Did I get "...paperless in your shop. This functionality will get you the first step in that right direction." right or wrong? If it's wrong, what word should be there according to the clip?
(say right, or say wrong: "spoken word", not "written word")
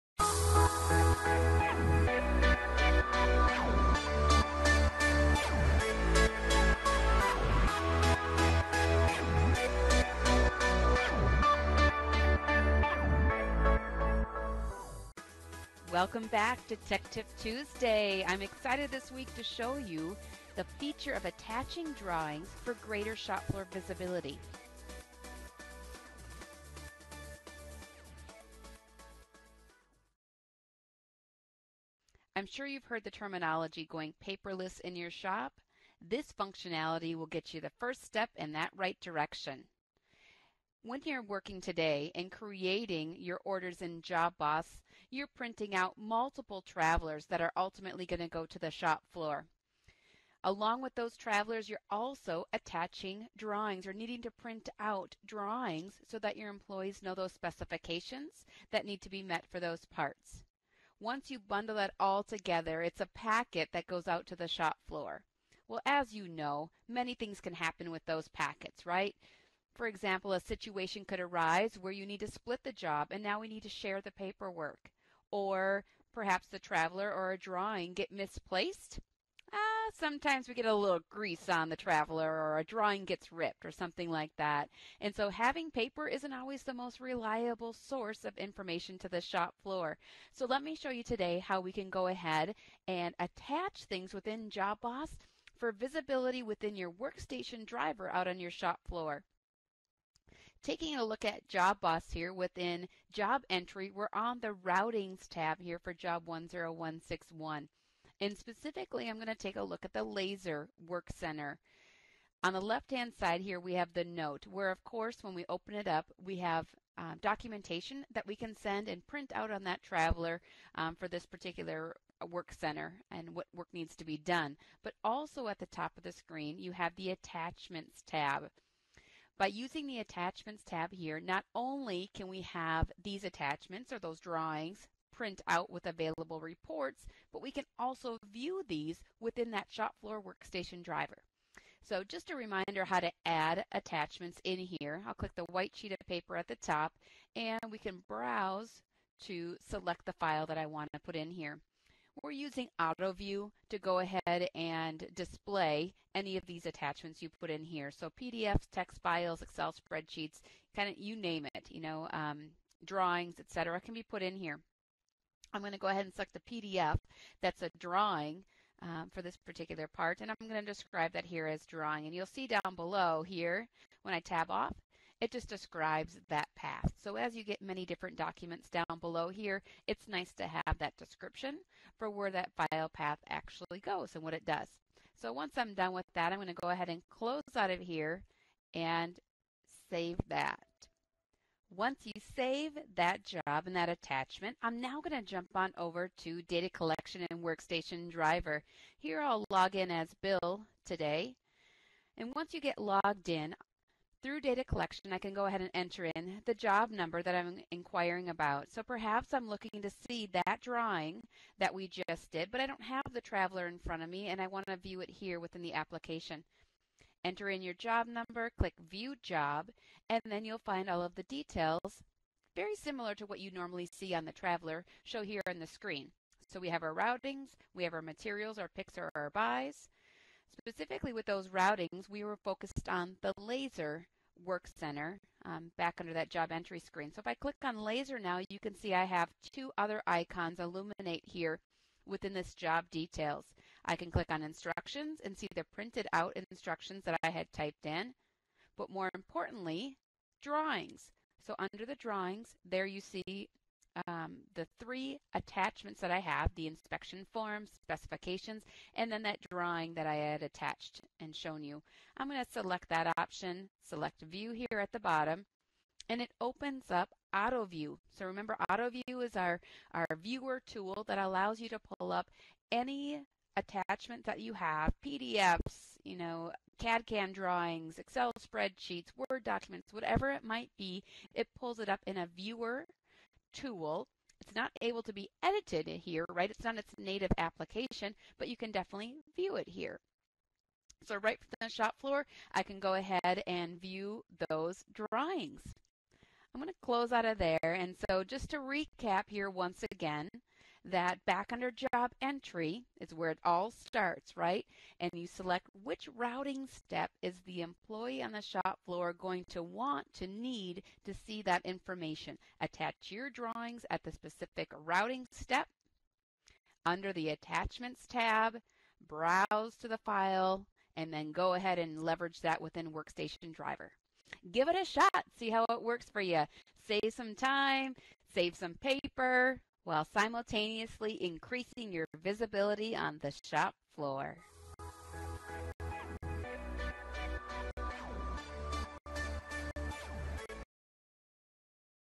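right.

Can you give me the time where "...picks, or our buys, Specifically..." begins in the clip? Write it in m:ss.
3:48.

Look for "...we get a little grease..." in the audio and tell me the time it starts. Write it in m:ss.
1:20.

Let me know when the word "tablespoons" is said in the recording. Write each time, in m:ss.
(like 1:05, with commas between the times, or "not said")
not said.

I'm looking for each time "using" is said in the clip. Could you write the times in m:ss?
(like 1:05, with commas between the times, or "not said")
2:09, 2:32.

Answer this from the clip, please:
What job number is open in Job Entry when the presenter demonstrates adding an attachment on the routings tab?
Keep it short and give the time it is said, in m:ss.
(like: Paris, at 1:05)
10161, at 1:46.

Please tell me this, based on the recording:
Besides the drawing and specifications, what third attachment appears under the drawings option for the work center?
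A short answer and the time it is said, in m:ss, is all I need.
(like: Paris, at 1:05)
inspection form, at 4:16.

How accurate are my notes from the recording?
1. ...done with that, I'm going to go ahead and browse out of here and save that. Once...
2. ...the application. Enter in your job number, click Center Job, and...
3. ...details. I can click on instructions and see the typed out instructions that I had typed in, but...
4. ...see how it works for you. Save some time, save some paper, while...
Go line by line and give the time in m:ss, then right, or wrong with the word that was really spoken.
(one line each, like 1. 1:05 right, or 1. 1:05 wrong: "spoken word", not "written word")
1. 3:05 wrong: "close", not "browse"
2. 3:35 wrong: "View", not "Center"
3. 4:02 wrong: "printed", not "typed"
4. 5:25 right.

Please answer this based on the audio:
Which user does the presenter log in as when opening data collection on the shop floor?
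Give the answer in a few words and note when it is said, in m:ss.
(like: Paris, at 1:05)
Bill, at 3:20.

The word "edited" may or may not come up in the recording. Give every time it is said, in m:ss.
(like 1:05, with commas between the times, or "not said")
4:45.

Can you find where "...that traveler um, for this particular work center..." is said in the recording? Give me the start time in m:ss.
1:59.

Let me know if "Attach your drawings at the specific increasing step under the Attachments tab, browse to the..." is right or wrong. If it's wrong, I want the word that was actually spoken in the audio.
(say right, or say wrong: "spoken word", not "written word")
wrong: "routing", not "increasing".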